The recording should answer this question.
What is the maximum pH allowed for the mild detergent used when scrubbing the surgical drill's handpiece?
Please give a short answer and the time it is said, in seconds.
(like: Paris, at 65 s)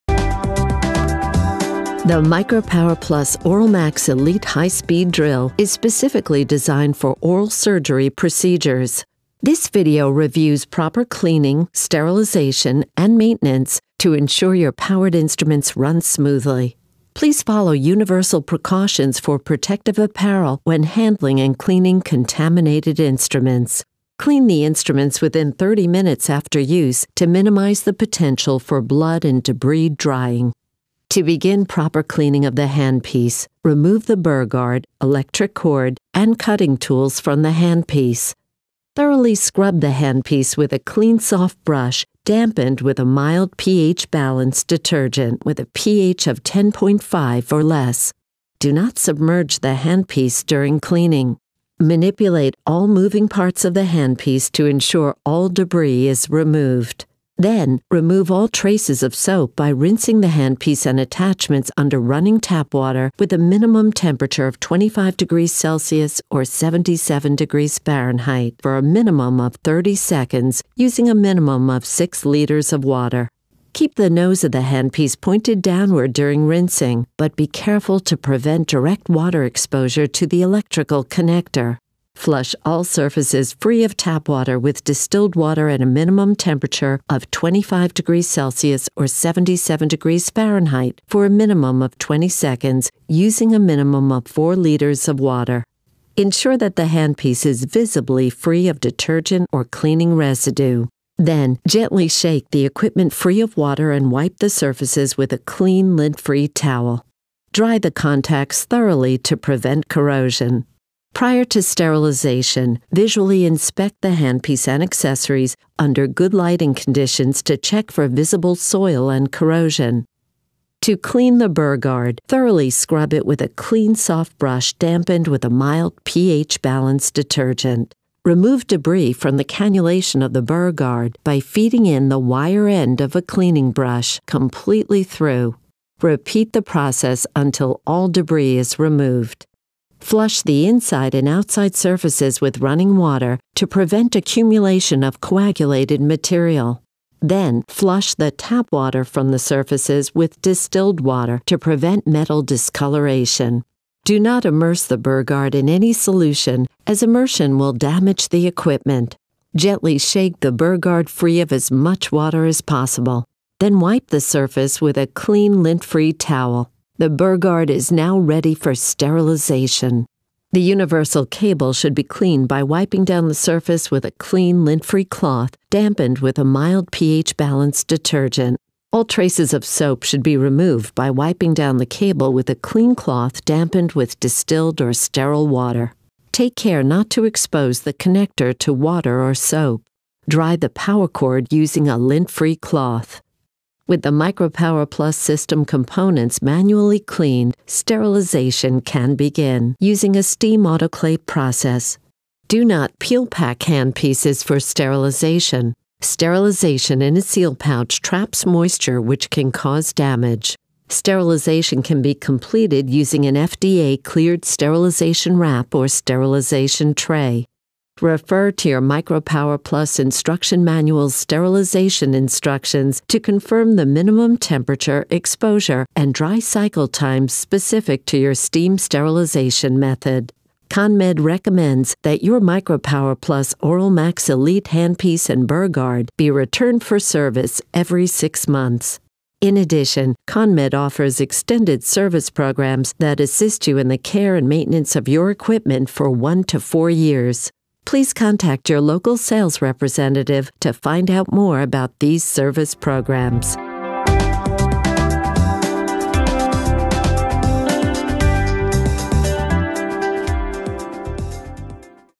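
10.5, at 46 s.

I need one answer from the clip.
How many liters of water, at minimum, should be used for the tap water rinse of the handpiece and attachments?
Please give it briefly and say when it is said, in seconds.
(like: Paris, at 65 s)
6, at 71 s.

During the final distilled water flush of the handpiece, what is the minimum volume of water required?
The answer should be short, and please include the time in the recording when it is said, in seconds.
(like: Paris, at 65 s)
4 liters, at 94 s.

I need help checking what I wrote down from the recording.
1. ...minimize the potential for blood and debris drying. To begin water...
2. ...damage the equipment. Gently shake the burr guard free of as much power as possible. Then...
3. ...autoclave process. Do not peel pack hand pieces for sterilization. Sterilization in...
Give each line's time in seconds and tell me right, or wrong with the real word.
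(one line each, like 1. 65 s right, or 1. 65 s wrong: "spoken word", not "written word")
1. 27 s wrong: "proper", not "water"
2. 157 s wrong: "water", not "power"
3. 200 s right.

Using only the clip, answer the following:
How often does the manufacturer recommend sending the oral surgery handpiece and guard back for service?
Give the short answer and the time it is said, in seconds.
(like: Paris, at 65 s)
every six months, at 237 s.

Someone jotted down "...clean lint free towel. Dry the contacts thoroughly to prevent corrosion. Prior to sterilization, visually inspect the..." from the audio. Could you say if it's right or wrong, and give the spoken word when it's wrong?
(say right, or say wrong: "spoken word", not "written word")
right.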